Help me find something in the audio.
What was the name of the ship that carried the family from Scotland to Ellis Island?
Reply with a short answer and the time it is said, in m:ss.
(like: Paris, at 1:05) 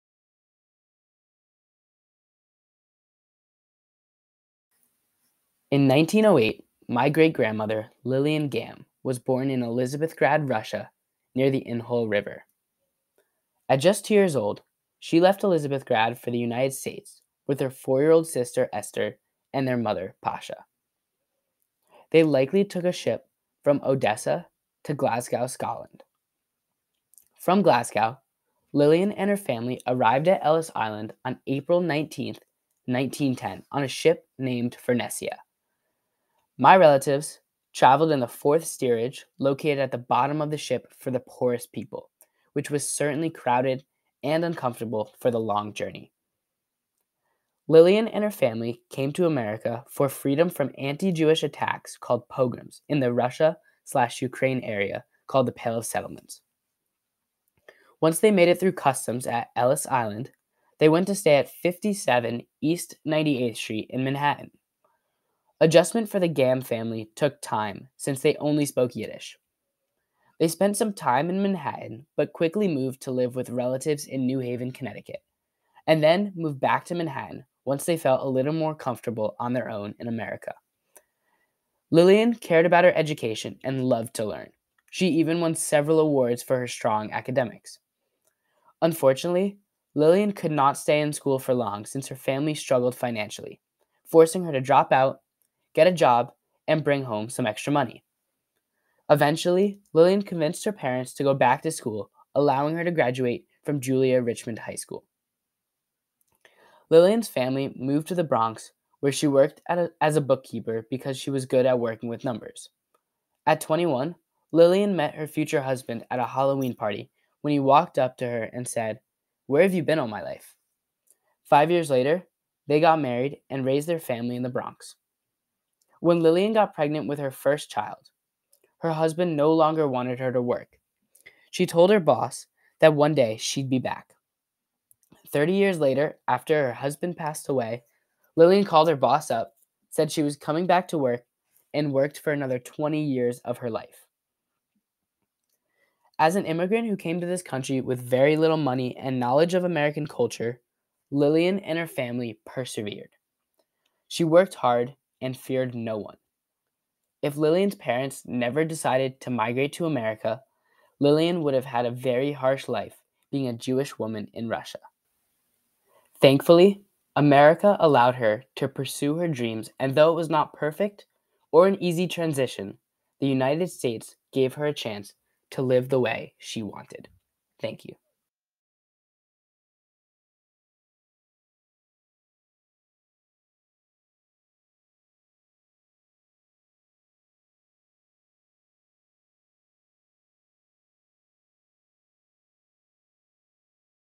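Furnessia, at 0:34.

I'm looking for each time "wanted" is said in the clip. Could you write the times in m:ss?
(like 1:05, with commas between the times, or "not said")
2:09, 2:56.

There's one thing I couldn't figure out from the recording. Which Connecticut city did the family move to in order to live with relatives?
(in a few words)
New Haven.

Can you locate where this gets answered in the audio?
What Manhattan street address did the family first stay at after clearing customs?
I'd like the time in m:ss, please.
1:01.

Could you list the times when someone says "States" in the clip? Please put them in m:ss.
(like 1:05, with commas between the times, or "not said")
0:16, 2:53.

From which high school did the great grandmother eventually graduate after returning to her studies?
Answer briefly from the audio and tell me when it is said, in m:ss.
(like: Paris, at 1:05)
Julia Richman High School, at 1:43.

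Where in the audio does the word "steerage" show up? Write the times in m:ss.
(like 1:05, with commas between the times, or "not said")
0:38.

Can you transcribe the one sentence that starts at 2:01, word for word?
Five years later, they got married and raised their family in the Bronx.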